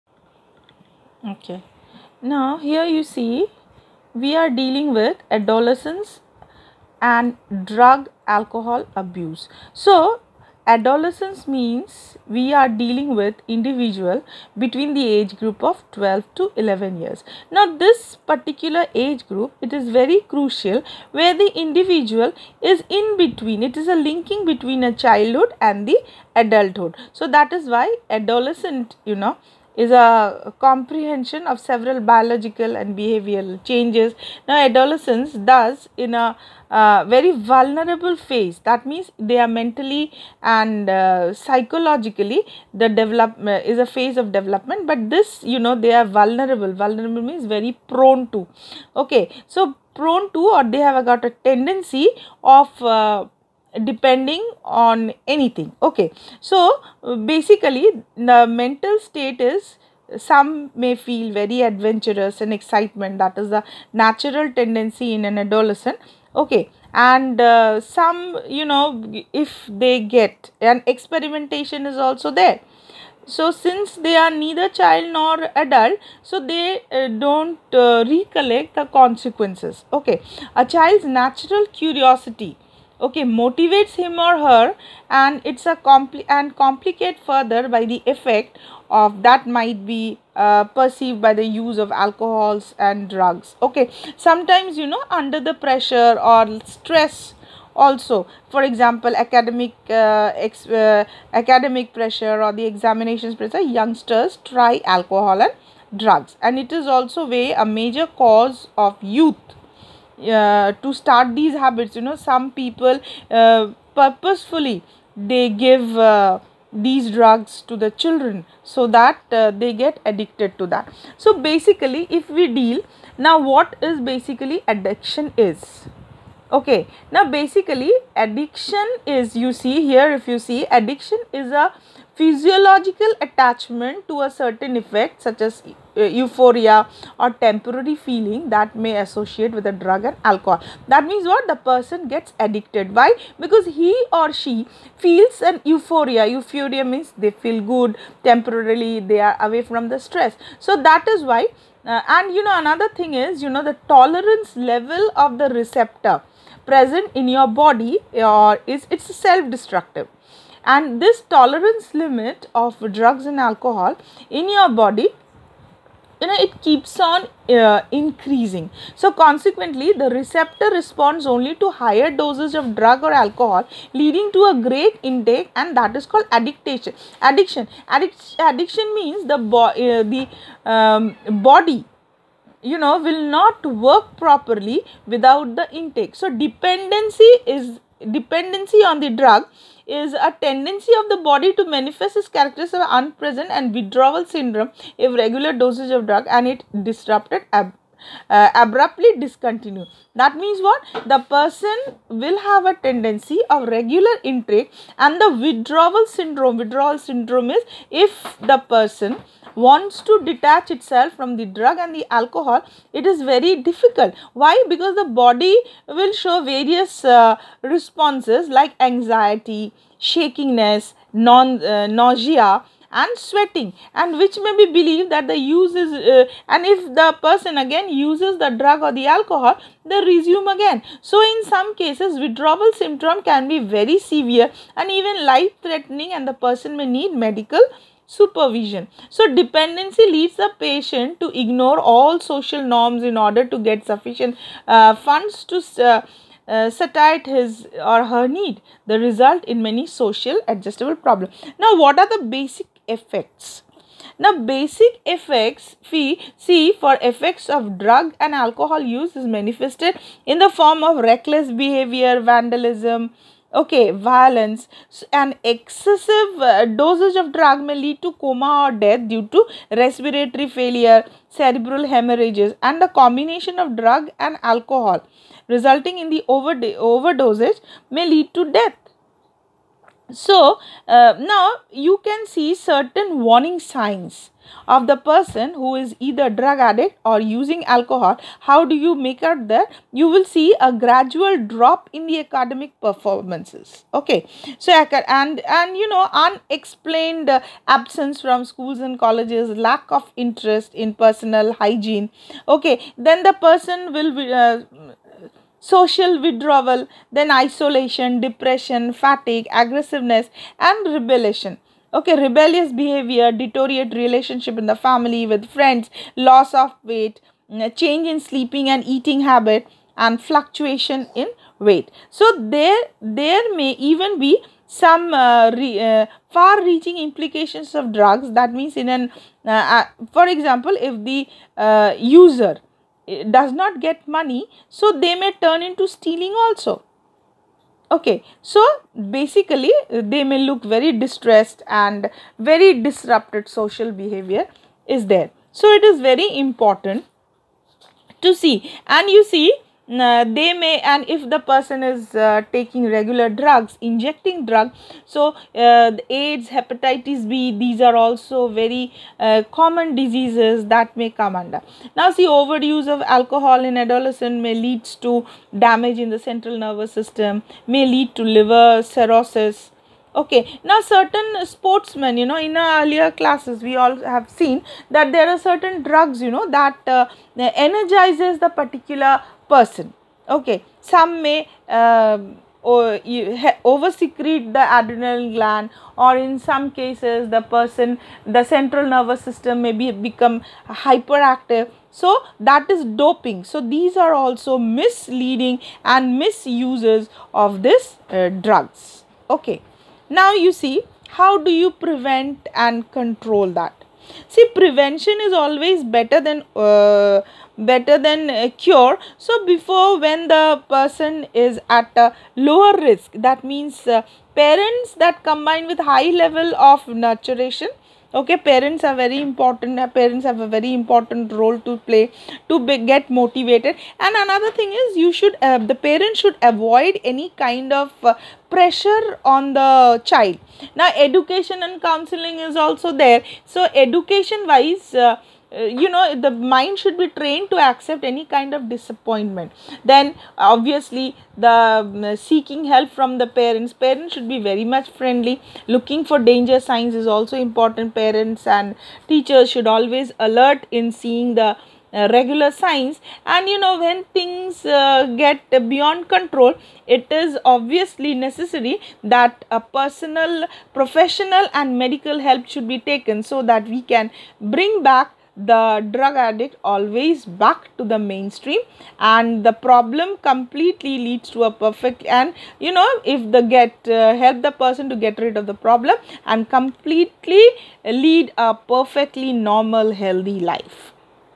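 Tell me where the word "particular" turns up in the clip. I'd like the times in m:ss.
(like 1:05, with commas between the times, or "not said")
0:18, 6:18.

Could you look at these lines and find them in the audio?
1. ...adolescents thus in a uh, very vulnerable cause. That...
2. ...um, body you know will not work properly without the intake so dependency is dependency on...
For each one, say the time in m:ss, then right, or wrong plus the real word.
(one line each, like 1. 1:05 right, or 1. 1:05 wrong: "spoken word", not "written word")
1. 0:34 wrong: "phase", not "cause"
2. 3:00 right.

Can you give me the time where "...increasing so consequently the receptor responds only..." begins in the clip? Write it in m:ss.
2:47.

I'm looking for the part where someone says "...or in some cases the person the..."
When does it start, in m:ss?
6:26.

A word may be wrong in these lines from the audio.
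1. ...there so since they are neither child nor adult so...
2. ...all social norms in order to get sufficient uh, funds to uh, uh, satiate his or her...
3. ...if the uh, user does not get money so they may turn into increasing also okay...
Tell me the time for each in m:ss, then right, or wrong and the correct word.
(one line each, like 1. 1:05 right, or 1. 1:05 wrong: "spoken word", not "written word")
1. 1:12 right
2. 4:01 right
3. 5:30 wrong: "stealing", not "increasing".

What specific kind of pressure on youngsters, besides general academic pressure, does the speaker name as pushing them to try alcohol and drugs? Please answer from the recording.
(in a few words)
Examinations pressure.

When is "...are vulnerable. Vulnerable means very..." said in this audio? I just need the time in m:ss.
0:45.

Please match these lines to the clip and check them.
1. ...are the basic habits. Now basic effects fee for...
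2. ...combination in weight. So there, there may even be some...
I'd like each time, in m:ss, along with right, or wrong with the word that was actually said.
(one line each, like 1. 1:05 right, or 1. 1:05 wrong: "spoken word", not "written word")
1. 4:11 wrong: "effects", not "habits"
2. 5:20 wrong: "fluctuation", not "combination".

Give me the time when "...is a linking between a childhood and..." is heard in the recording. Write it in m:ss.
0:23.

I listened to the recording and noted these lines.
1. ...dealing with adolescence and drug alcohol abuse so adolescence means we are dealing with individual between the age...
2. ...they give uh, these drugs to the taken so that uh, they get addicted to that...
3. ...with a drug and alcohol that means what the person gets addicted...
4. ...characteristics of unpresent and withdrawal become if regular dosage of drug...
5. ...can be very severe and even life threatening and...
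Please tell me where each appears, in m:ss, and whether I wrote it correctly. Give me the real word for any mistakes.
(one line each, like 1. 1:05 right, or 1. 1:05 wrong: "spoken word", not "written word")
1. 0:04 right
2. 1:55 wrong: "children", not "taken"
3. 2:19 right
4. 3:12 wrong: "syndrome", not "become"
5. 3:53 right.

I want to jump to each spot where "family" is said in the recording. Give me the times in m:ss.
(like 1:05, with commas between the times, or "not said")
5:14.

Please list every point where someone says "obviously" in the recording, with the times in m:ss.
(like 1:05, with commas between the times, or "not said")
7:20, 7:37.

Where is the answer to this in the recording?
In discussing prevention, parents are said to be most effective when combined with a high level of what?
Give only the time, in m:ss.
6:56.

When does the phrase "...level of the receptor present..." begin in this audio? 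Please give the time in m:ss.
2:34.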